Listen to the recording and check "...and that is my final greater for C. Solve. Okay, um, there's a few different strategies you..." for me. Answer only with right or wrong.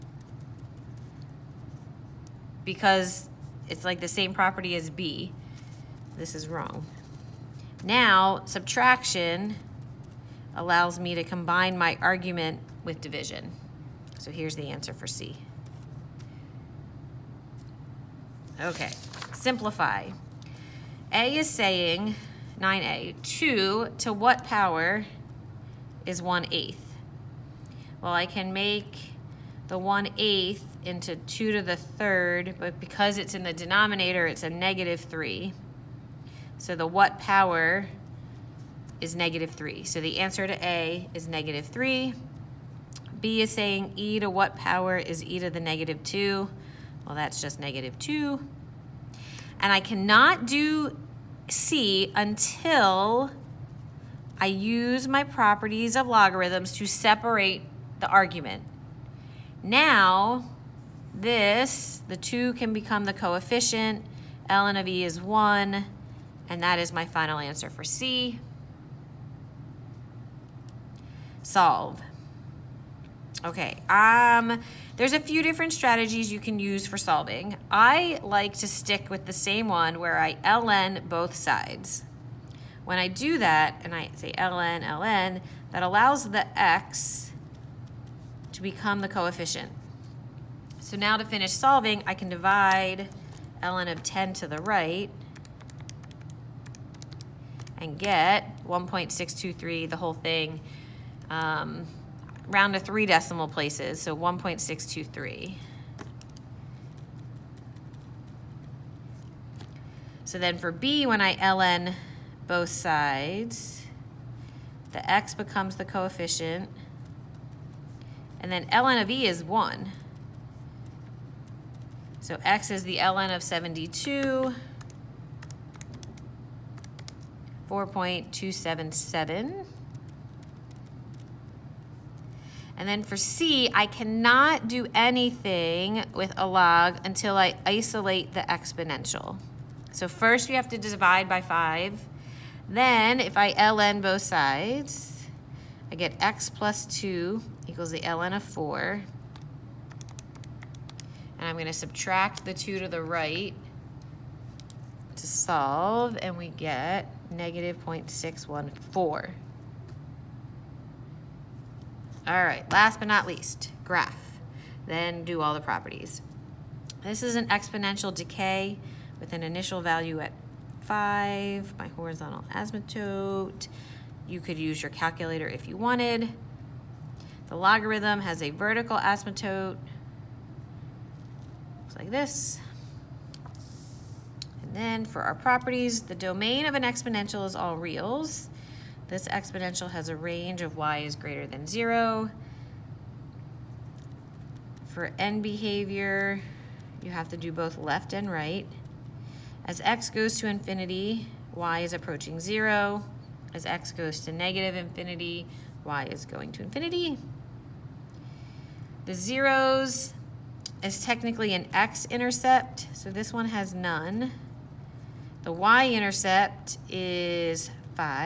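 wrong.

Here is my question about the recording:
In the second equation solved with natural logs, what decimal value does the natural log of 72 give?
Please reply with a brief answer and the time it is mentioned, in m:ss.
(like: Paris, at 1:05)
4.277, at 2:07.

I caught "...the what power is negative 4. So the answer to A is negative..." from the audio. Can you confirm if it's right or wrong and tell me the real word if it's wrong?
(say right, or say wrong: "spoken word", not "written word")
wrong: "3", not "4".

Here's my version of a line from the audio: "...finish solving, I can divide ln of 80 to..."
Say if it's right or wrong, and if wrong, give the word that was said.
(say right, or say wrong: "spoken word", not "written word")
wrong: "10", not "80".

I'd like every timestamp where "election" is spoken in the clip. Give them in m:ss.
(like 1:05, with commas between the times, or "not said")
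not said.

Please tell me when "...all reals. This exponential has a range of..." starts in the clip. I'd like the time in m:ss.
3:07.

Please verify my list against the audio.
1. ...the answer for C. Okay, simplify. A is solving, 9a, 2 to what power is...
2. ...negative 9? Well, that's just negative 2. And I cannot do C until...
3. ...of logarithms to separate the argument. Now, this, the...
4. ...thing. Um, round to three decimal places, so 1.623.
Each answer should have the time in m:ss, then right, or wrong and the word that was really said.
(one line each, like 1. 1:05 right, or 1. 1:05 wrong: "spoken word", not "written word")
1. 0:14 wrong: "saying", not "solving"
2. 0:45 wrong: "2", not "9"
3. 0:55 right
4. 1:40 right.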